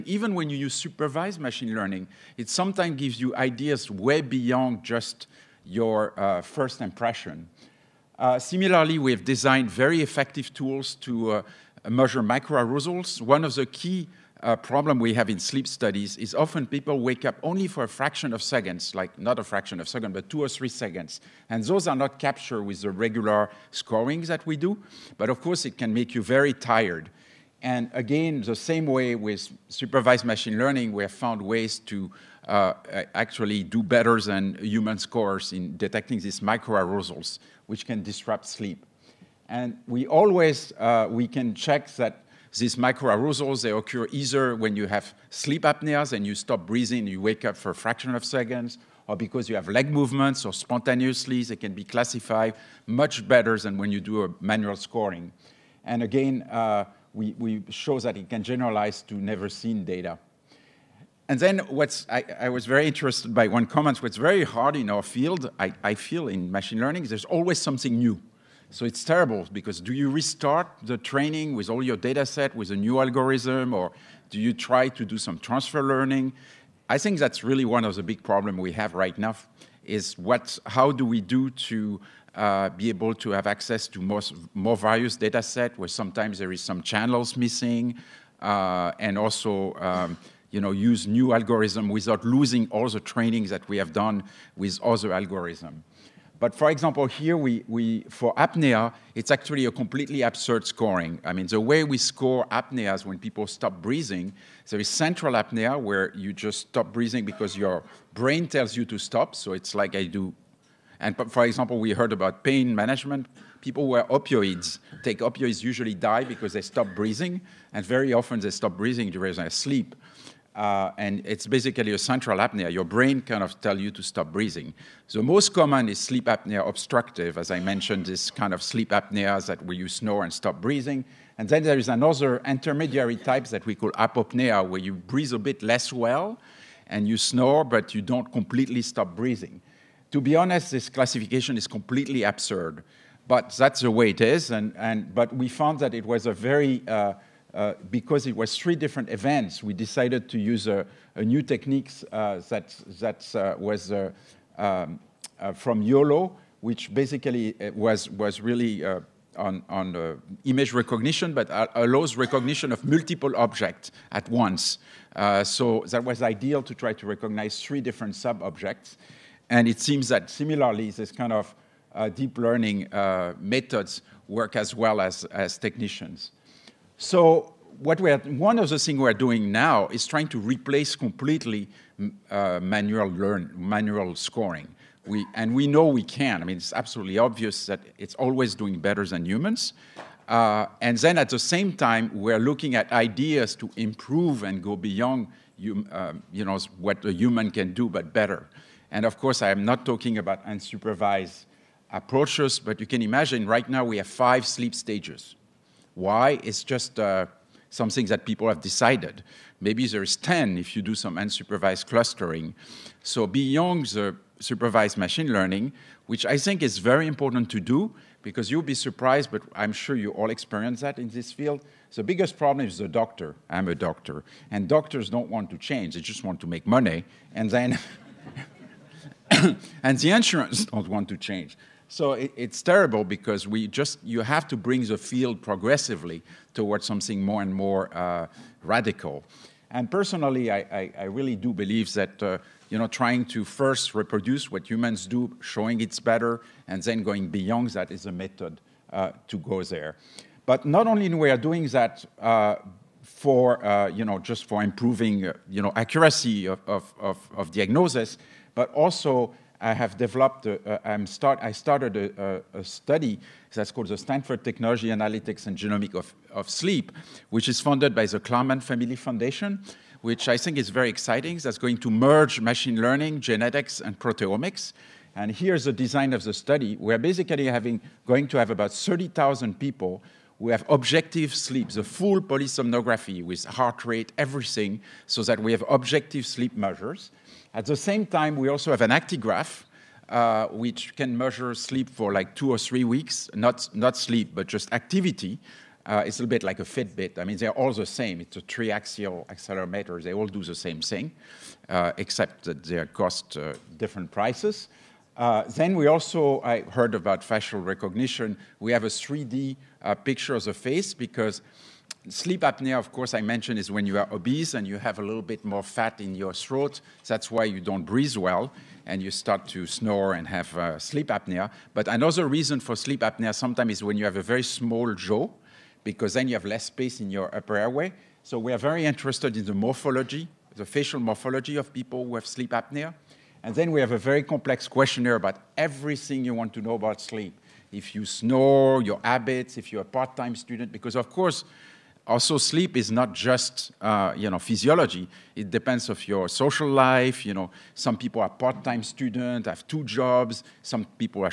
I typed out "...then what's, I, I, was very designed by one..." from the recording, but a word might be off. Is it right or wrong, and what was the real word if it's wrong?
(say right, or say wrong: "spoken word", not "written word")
wrong: "interested", not "designed".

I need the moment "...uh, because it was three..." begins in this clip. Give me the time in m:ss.
2:27.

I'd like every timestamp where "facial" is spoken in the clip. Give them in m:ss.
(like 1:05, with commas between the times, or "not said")
5:07, 5:30.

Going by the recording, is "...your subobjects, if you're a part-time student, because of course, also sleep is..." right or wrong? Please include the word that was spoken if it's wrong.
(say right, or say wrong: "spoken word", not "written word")
wrong: "habits", not "subobjects".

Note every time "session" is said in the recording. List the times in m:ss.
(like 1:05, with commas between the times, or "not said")
not said.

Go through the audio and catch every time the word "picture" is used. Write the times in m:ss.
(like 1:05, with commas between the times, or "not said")
5:09.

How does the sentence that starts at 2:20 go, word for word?
To be honest, this classification is completely absurd, but that's the way it is.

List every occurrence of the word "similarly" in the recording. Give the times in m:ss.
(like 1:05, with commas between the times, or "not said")
0:08, 2:50.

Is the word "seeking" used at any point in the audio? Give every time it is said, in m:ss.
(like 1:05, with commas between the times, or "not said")
not said.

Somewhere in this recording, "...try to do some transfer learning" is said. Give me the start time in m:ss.
1:14.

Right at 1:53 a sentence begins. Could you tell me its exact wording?
People who are opioids take opioids usually die because they stop breathing, and very often they stop breathing during their sleep.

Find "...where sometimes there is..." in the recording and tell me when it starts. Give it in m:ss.
1:25.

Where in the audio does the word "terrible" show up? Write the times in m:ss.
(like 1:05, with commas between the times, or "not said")
1:09, 3:52.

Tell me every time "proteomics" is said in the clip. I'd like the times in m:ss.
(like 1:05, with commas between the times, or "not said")
4:33.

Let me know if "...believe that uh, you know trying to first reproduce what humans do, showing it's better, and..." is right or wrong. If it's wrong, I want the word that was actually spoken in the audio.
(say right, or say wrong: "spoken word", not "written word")
right.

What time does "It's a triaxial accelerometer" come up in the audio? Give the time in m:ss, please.
4:58.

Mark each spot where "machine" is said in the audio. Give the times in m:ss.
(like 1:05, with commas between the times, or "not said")
0:01, 0:30, 1:06, 3:34, 4:32.